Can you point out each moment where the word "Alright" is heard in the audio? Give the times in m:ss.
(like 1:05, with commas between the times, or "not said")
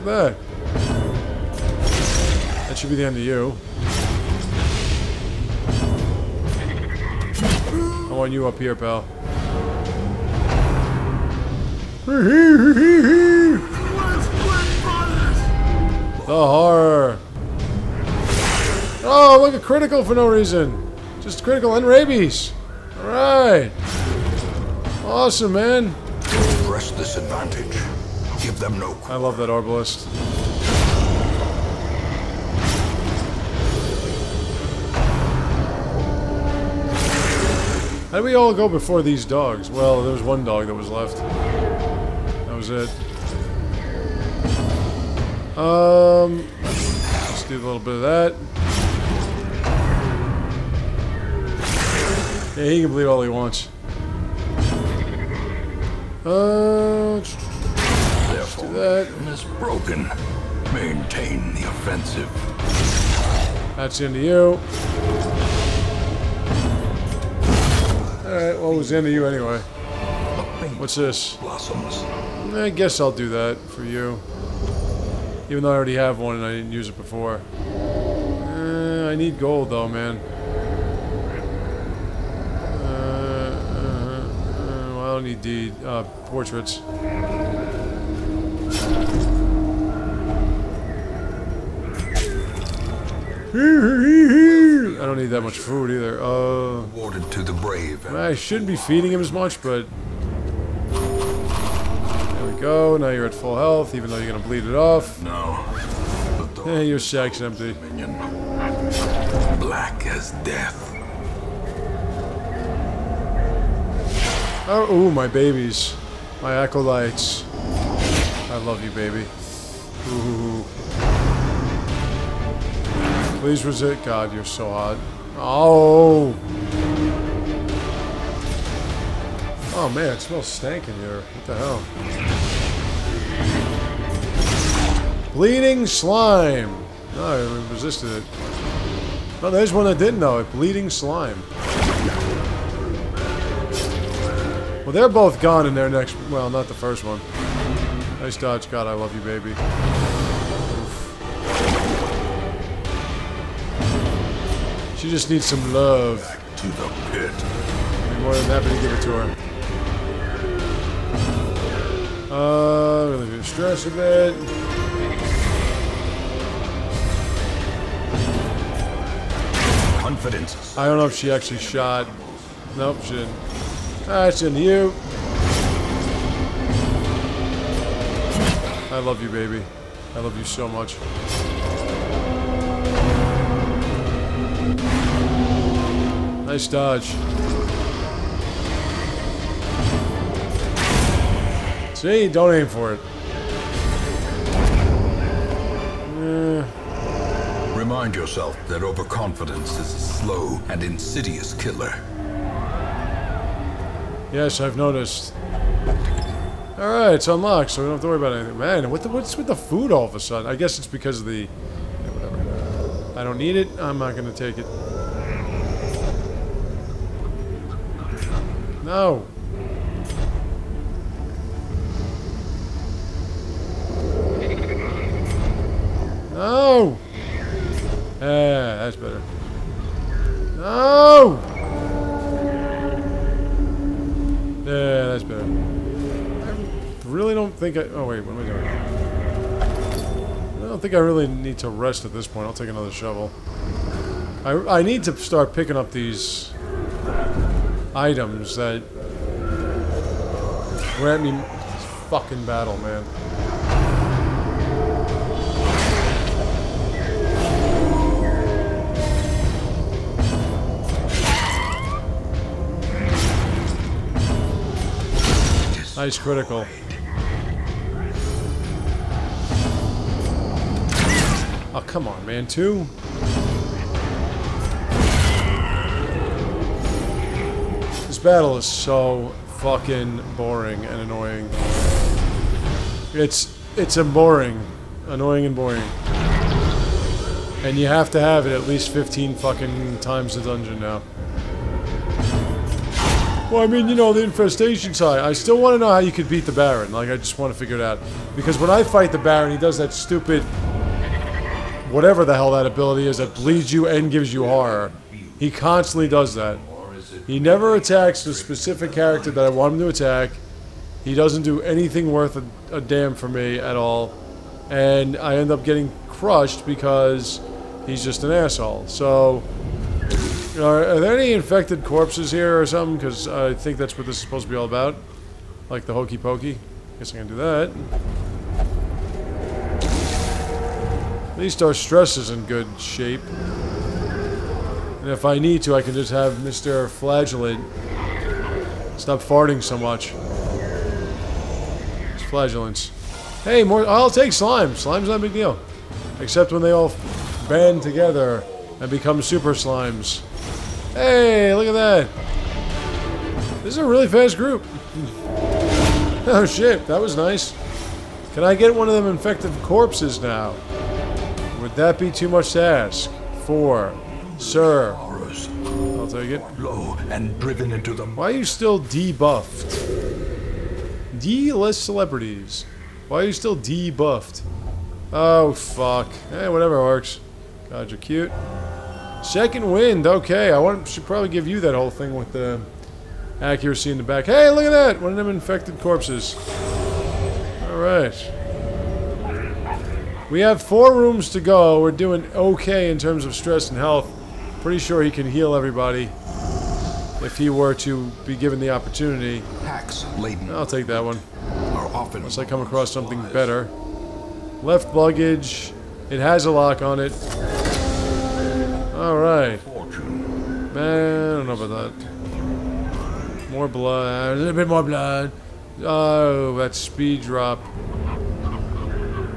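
0:22, 1:08, 3:26, 6:48.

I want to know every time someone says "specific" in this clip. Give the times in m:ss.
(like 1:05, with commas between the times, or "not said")
5:08.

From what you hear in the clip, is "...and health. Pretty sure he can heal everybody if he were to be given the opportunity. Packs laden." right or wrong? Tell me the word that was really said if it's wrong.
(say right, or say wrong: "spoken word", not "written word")
right.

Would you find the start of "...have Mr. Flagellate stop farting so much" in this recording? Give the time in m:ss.
5:36.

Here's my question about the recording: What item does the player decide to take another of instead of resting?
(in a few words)
Shovel.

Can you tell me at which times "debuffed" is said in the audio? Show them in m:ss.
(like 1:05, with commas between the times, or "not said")
6:08, 6:13.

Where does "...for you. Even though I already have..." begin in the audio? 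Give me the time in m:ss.
1:13.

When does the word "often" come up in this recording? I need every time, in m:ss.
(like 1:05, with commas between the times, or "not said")
6:41.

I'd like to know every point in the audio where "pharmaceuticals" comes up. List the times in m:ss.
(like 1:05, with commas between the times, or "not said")
not said.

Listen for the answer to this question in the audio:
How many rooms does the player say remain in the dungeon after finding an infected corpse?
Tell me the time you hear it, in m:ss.
6:30.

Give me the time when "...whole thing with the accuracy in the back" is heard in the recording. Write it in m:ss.
6:21.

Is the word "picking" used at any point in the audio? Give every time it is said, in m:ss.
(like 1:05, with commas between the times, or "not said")
4:05.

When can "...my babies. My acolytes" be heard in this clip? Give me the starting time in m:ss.
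1:55.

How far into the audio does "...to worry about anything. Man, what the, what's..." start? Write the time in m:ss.
3:28.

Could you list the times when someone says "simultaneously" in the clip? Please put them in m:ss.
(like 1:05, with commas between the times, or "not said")
not said.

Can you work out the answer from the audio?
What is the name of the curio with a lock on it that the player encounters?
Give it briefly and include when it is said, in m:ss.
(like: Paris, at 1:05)
Left luggage, at 6:44.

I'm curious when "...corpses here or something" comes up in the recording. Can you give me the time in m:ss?
5:21.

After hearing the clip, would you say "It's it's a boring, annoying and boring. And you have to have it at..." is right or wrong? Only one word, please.
right.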